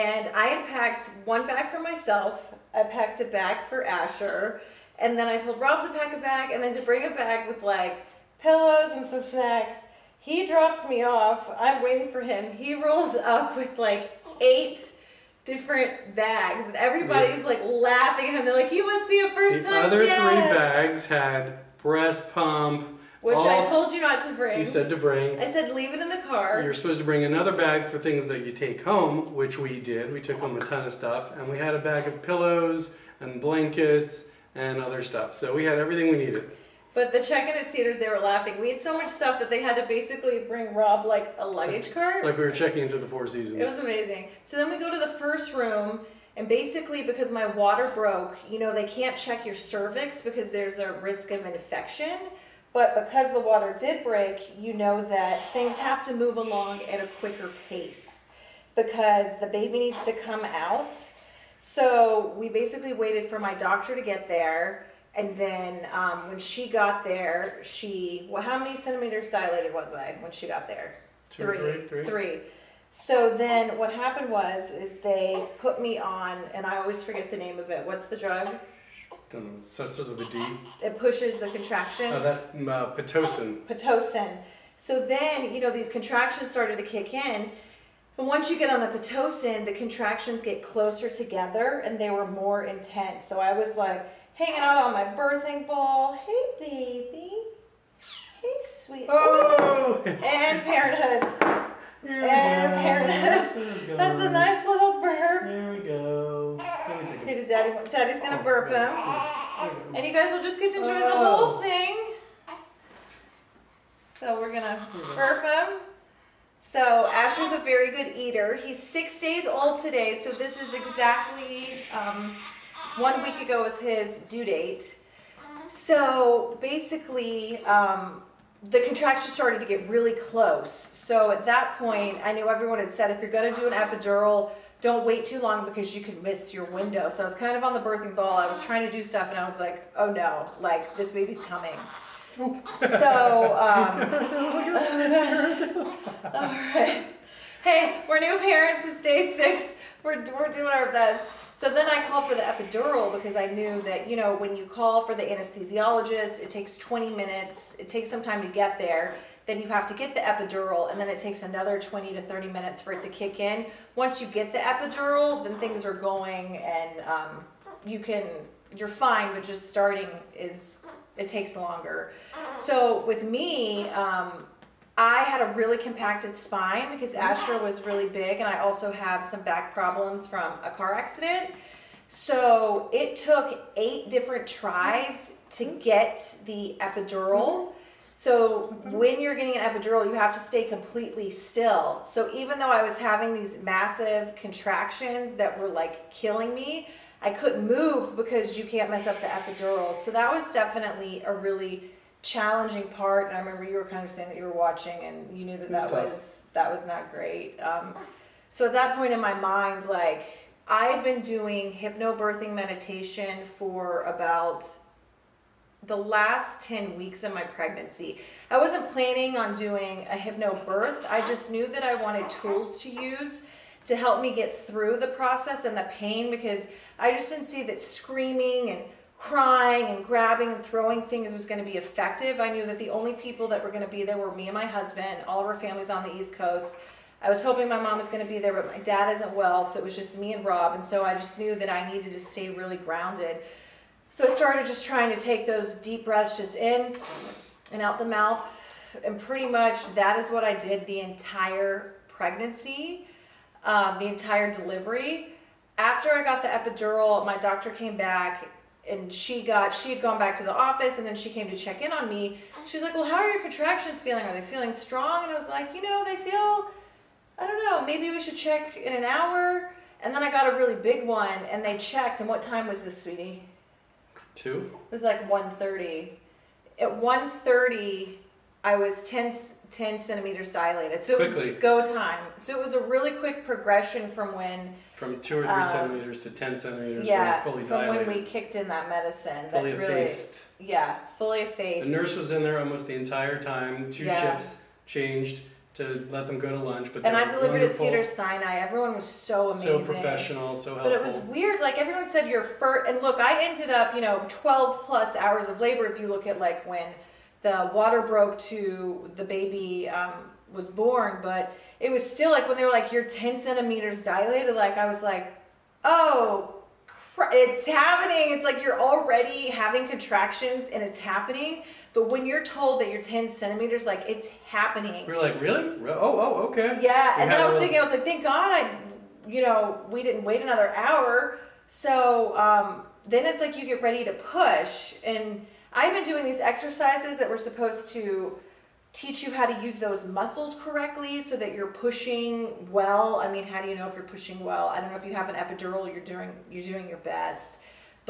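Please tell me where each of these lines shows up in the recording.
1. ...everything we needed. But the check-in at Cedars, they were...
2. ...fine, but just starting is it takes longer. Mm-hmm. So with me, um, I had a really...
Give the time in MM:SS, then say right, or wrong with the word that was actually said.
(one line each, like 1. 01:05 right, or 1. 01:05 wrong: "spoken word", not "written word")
1. 00:35 right
2. 02:48 right.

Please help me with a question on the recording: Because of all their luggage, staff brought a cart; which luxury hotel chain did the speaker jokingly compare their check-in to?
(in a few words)
Four Seasons.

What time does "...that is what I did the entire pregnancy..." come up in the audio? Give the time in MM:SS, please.
04:09.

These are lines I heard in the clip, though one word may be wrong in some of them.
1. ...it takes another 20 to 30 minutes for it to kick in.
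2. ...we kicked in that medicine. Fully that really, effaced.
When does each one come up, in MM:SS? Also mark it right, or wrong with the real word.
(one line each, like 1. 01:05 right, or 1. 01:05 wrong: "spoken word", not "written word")
1. 02:41 right
2. 04:48 right.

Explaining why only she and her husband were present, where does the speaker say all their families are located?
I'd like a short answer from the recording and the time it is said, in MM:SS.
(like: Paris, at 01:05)
East Coast, at 03:56.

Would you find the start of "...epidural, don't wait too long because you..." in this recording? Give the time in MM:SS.
02:13.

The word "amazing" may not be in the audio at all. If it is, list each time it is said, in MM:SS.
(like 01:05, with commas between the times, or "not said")
00:43, 04:59.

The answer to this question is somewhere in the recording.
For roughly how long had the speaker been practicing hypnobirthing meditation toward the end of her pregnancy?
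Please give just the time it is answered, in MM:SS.
03:36.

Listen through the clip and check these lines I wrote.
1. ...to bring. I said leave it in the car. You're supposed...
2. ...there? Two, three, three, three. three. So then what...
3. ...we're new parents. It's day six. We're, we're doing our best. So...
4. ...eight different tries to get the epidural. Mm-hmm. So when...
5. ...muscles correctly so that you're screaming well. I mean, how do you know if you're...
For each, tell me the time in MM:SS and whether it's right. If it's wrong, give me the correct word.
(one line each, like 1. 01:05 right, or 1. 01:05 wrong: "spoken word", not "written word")
1. 00:24 right
2. 01:10 right
3. 02:28 right
4. 03:03 right
5. 05:40 wrong: "pushing", not "screaming".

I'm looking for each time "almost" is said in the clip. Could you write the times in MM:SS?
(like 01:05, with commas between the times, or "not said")
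04:52.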